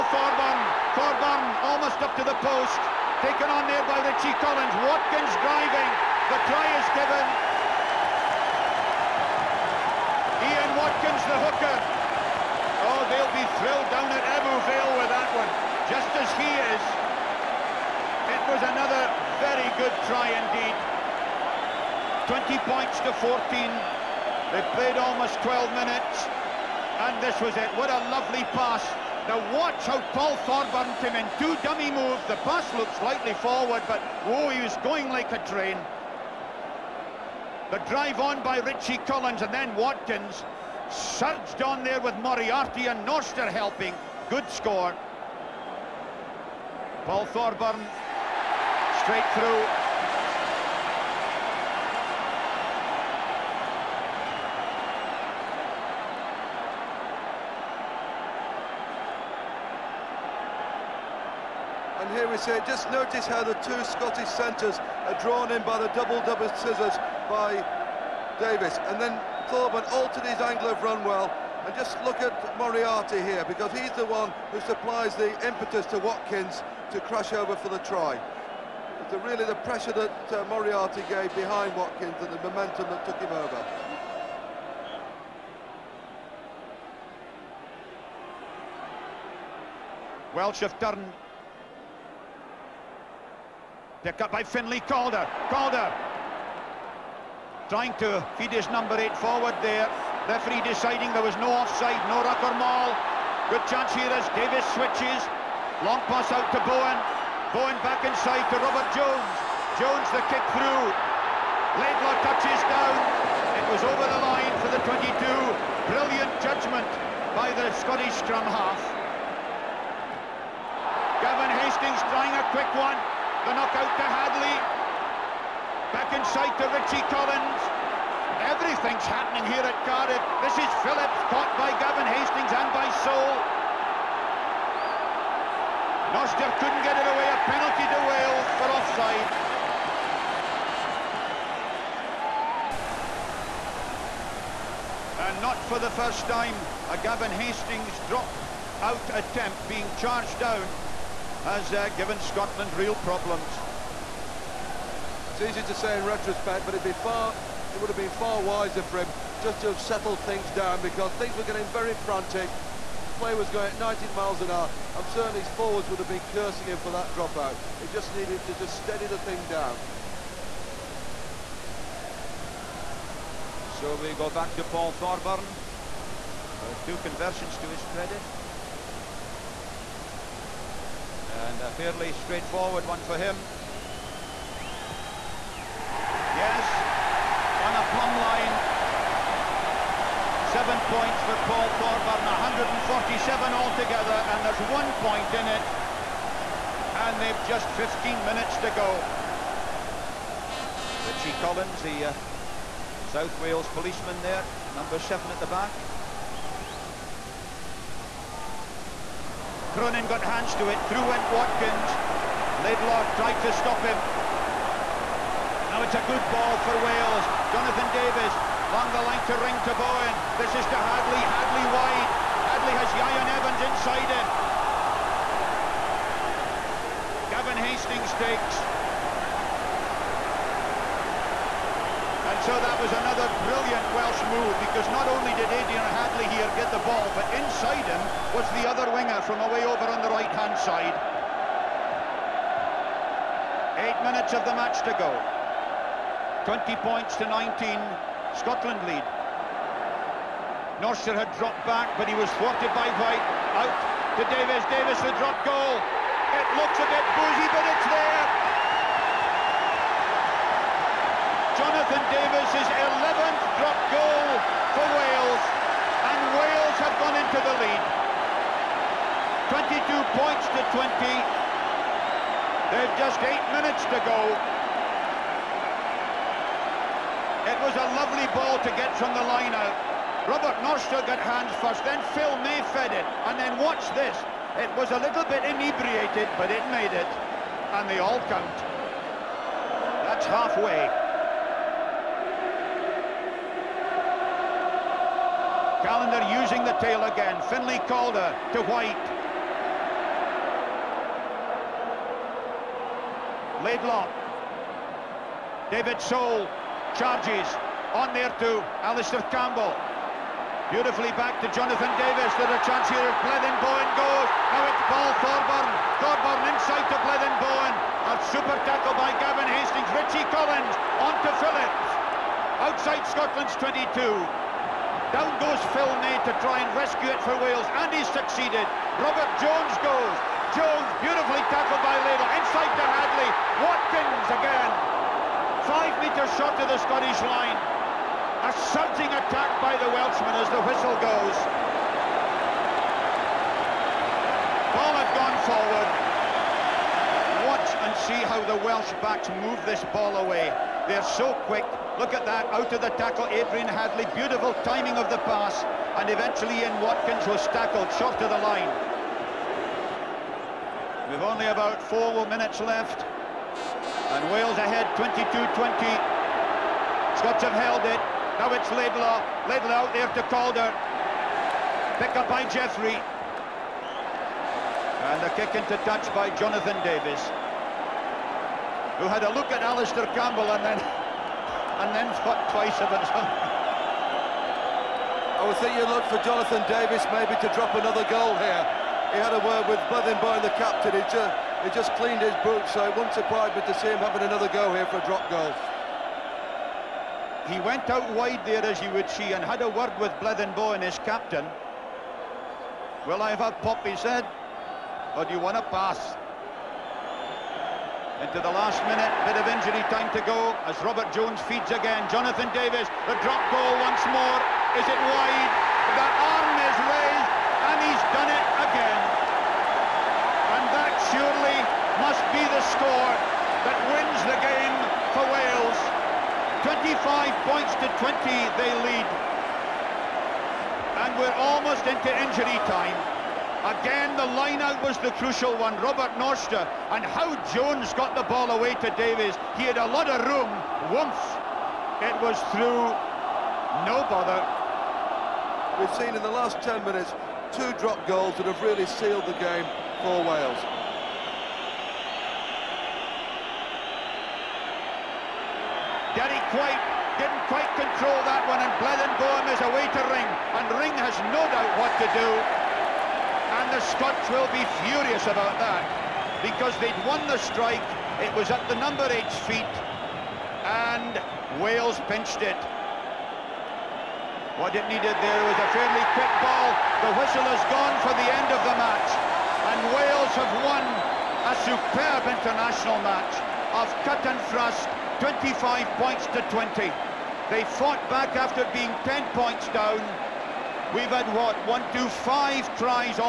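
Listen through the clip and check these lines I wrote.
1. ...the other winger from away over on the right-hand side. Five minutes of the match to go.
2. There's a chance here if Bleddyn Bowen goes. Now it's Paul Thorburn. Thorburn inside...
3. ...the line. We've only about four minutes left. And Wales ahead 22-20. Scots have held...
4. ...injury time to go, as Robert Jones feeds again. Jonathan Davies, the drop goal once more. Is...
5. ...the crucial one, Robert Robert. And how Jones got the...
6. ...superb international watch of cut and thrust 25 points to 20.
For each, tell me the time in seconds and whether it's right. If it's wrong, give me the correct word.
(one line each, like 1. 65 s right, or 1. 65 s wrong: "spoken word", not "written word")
1. 238 s wrong: "Eight", not "Five"
2. 312 s right
3. 358 s right
4. 409 s right
5. 435 s wrong: "Norster", not "Robert"
6. 481 s wrong: "match", not "watch".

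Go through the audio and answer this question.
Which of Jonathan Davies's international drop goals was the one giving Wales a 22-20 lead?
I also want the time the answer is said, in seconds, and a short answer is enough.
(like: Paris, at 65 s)
11th, at 262 s.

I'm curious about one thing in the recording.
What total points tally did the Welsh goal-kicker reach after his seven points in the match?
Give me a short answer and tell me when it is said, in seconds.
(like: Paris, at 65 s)
147, at 192 s.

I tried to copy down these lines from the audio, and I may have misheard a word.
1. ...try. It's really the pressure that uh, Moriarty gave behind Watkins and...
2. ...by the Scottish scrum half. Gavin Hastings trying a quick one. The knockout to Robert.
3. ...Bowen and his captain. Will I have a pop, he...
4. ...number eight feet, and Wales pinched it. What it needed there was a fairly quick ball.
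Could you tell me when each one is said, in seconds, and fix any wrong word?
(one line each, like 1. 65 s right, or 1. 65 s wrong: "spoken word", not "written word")
1. 77 s right
2. 117 s wrong: "Hadley", not "Robert"
3. 400 s right
4. 468 s right.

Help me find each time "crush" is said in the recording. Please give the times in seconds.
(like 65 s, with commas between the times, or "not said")
77 s.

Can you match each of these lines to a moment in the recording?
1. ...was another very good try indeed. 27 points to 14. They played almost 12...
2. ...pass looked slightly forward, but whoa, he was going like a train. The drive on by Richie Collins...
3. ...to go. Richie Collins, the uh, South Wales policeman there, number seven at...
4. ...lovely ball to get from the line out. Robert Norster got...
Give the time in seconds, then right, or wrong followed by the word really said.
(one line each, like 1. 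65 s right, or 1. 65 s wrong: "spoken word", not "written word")
1. 18 s wrong: "20", not "27"
2. 32 s right
3. 198 s right
4. 277 s right.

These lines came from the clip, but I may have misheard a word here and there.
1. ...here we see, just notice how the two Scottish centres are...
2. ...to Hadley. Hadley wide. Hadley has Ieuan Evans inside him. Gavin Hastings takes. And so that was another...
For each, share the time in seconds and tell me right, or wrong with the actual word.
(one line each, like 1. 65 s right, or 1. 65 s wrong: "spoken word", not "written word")
1. 62 s right
2. 220 s right.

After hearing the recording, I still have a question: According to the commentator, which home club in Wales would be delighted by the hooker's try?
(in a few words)
Ebbw Vale.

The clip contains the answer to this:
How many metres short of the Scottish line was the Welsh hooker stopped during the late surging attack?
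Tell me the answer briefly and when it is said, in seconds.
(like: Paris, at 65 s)
5 meters, at 335 s.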